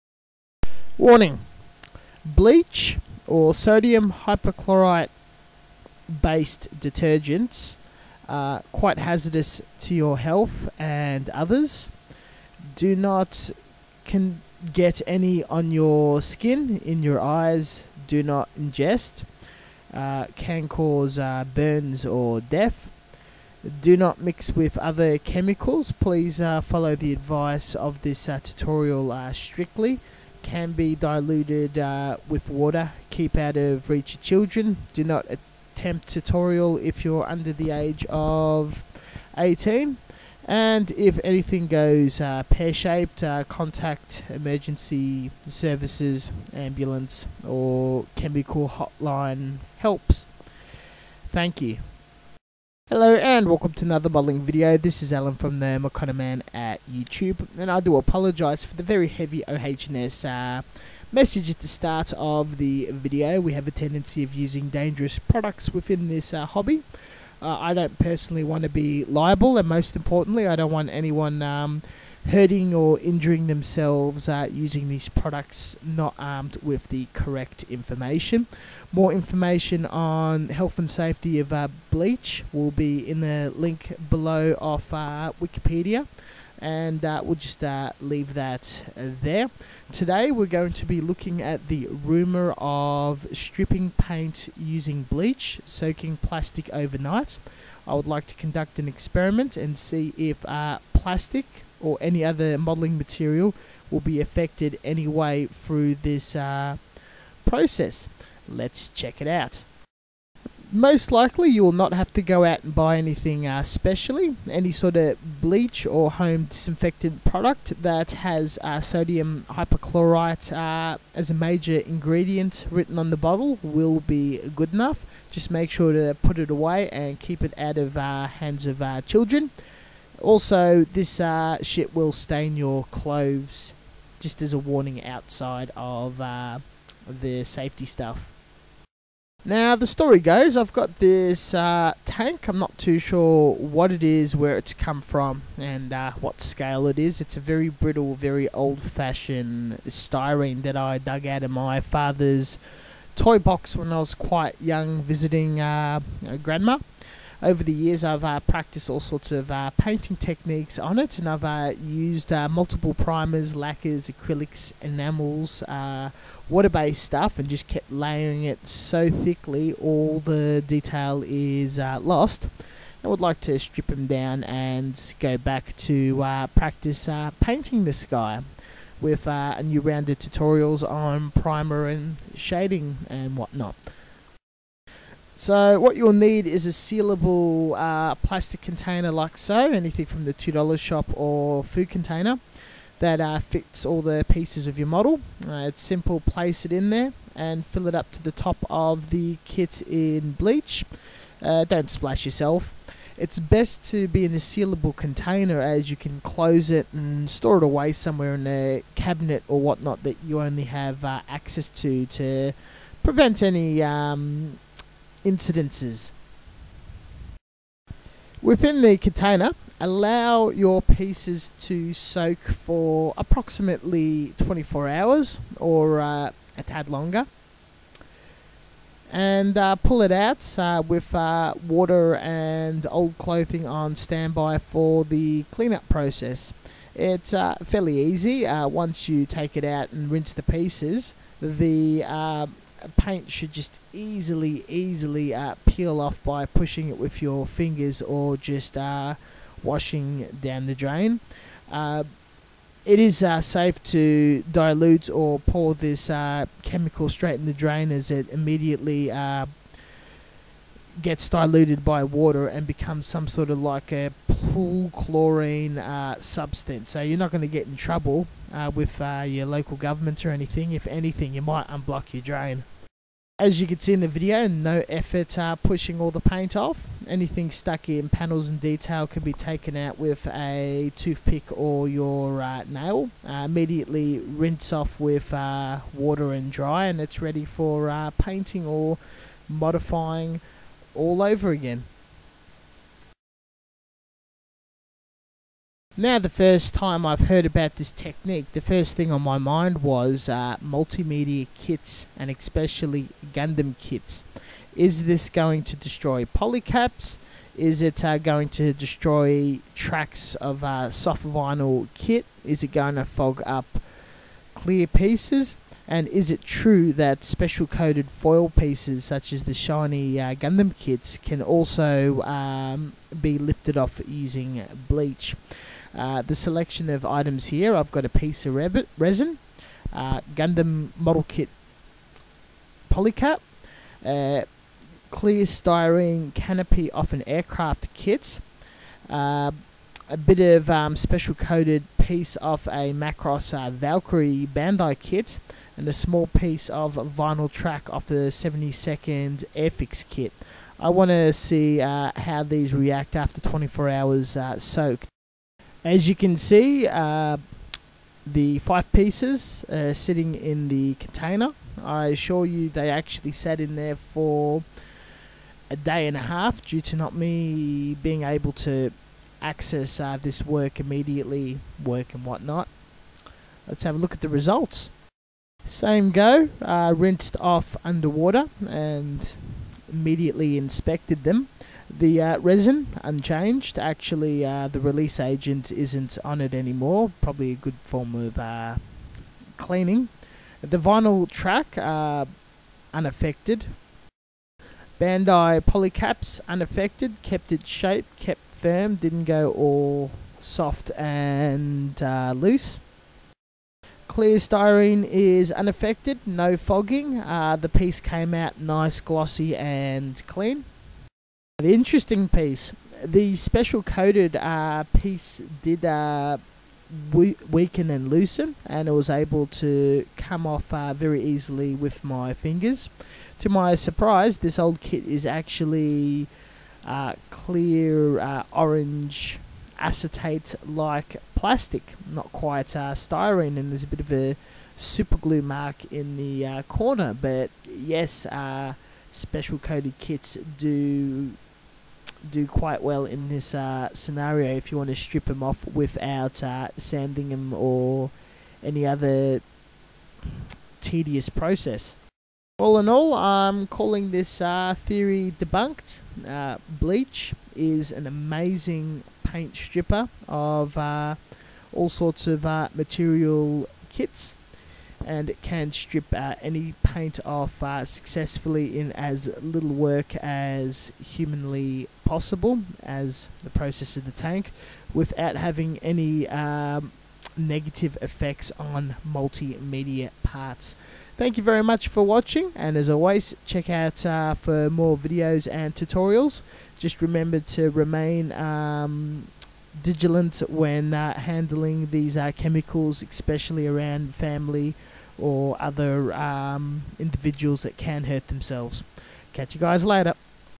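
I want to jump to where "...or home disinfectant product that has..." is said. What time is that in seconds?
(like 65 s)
115 s.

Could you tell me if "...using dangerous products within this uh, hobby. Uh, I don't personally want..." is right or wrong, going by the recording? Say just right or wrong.
right.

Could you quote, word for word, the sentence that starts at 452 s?
All in all, I'm calling this uh, theory debunked.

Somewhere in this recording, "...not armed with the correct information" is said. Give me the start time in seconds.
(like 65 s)
75 s.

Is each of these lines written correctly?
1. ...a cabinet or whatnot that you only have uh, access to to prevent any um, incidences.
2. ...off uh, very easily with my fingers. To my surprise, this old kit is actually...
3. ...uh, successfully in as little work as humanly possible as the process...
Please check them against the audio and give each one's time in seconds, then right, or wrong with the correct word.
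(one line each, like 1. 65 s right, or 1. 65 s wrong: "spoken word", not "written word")
1. 208 s right
2. 420 s right
3. 467 s right.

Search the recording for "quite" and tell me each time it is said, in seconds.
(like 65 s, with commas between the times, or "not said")
8 s, 154 s, 432 s, 442 s.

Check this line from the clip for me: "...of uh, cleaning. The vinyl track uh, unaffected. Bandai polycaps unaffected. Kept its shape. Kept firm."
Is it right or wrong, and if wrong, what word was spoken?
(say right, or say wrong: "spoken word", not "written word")
right.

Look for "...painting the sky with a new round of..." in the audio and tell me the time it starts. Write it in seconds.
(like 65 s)
177 s.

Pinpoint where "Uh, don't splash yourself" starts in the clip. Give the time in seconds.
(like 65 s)
201 s.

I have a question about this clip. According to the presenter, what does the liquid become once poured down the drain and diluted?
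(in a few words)
pool chlorine.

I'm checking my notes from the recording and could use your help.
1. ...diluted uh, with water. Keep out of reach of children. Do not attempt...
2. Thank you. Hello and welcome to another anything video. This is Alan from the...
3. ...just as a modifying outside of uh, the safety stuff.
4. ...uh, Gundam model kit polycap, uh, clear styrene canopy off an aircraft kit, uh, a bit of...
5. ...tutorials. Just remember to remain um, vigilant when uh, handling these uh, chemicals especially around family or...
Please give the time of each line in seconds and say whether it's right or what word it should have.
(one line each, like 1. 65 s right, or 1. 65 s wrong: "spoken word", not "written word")
1. 30 s right
2. 51 s wrong: "modeling", not "anything"
3. 134 s wrong: "warning", not "modifying"
4. 329 s right
5. 485 s right.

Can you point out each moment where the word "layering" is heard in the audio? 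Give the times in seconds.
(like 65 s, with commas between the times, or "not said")
167 s.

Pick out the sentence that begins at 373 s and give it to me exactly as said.
Let's have a look at the results.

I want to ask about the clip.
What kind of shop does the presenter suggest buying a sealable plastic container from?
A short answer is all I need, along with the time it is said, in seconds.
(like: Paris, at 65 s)
the $2 shop, at 190 s.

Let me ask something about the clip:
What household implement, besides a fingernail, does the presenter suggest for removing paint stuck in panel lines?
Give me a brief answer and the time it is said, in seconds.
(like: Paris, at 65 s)
a toothpick, at 280 s.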